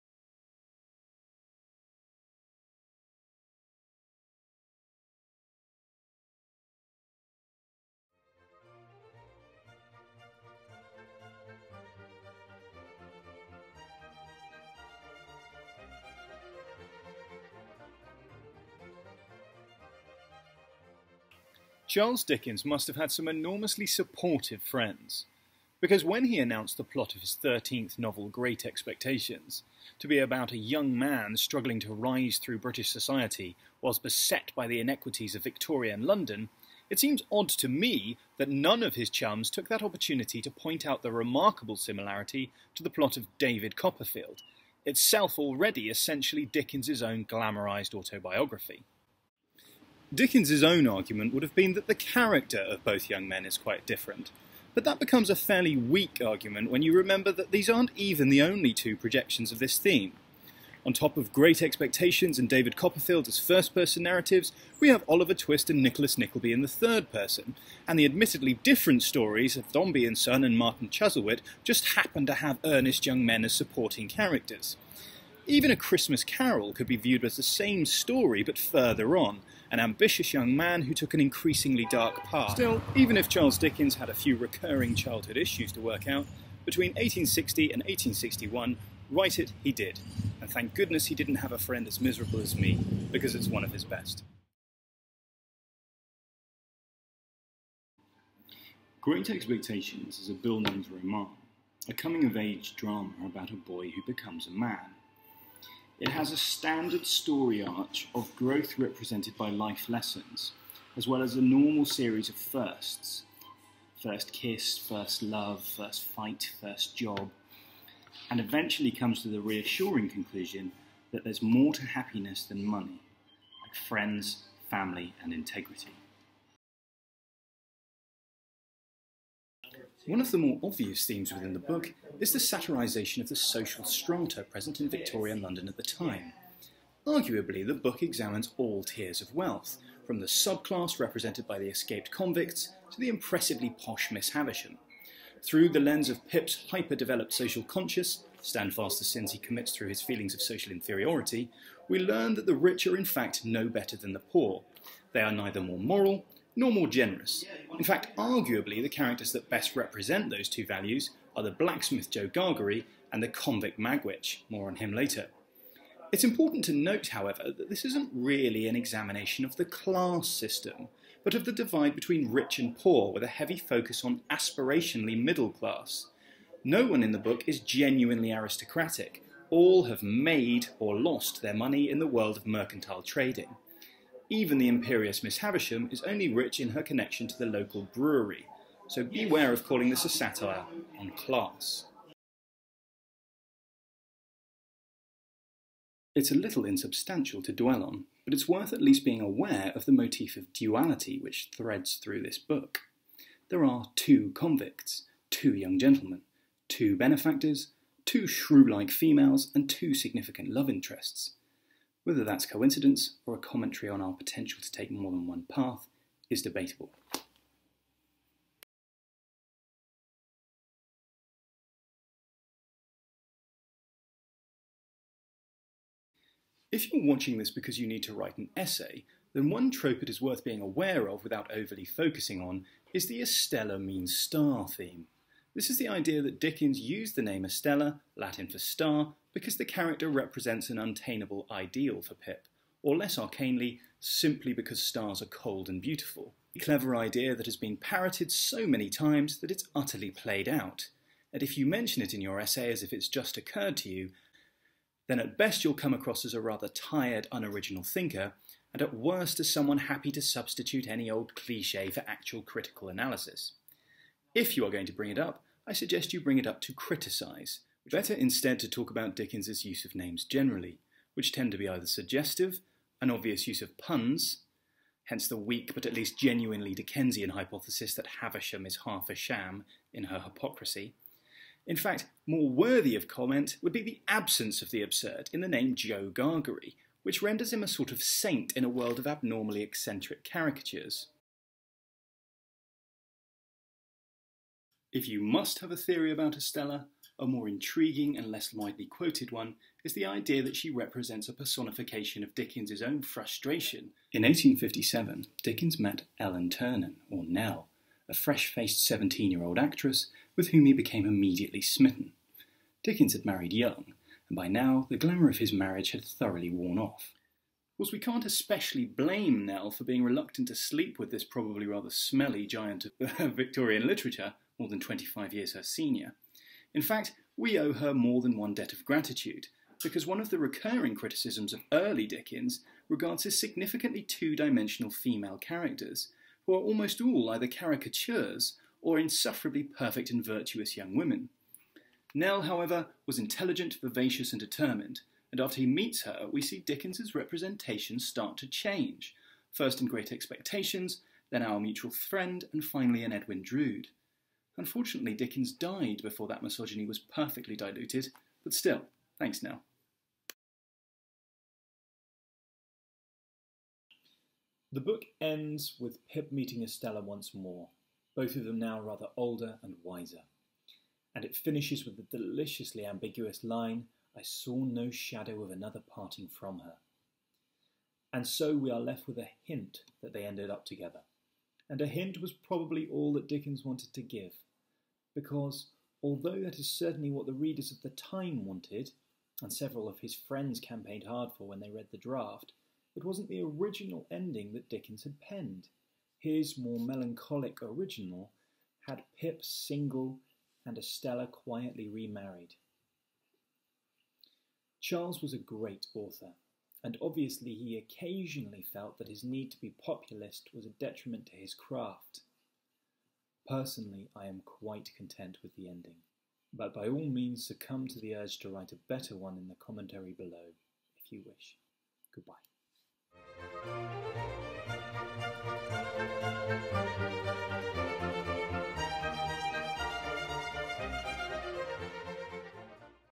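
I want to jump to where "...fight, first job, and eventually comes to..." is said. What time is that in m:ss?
1:56.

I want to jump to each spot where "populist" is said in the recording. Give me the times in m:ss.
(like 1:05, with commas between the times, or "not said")
6:49.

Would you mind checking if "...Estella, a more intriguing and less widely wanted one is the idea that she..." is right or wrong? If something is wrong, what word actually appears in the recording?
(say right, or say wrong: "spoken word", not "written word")
wrong: "quoted", not "wanted".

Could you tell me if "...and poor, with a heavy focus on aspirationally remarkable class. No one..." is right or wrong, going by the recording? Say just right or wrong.
wrong.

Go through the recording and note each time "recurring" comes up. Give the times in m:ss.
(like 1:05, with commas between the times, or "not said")
1:24, 5:30.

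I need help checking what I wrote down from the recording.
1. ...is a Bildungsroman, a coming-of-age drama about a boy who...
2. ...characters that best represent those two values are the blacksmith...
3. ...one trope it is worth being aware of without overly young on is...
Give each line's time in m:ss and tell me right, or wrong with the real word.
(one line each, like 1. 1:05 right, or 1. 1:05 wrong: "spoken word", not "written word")
1. 1:40 right
2. 2:38 right
3. 3:49 wrong: "focusing", not "young".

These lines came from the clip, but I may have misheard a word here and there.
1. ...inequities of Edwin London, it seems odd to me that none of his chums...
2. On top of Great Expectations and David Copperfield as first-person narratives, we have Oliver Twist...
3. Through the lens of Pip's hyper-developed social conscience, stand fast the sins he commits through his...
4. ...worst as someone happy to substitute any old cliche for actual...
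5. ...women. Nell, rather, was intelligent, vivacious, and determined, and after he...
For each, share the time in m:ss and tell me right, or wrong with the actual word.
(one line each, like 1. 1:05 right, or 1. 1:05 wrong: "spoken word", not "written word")
1. 0:34 wrong: "Victorian", not "Edwin"
2. 1:00 right
3. 2:25 right
4. 4:18 right
5. 5:40 wrong: "however", not "rather".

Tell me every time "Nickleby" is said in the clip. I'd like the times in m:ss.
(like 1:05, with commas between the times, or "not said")
1:06.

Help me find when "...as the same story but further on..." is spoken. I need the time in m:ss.
1:17.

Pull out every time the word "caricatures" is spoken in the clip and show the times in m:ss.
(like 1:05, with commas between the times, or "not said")
4:50, 5:37.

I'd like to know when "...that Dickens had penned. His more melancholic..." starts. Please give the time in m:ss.
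6:34.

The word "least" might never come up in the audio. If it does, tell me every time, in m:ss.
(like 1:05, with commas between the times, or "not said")
3:18, 4:35.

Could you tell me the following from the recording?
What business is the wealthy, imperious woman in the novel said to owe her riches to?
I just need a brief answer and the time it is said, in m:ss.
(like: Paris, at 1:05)
the local brewery, at 3:07.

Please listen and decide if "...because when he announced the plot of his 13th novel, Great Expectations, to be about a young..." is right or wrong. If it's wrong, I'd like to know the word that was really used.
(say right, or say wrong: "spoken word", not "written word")
right.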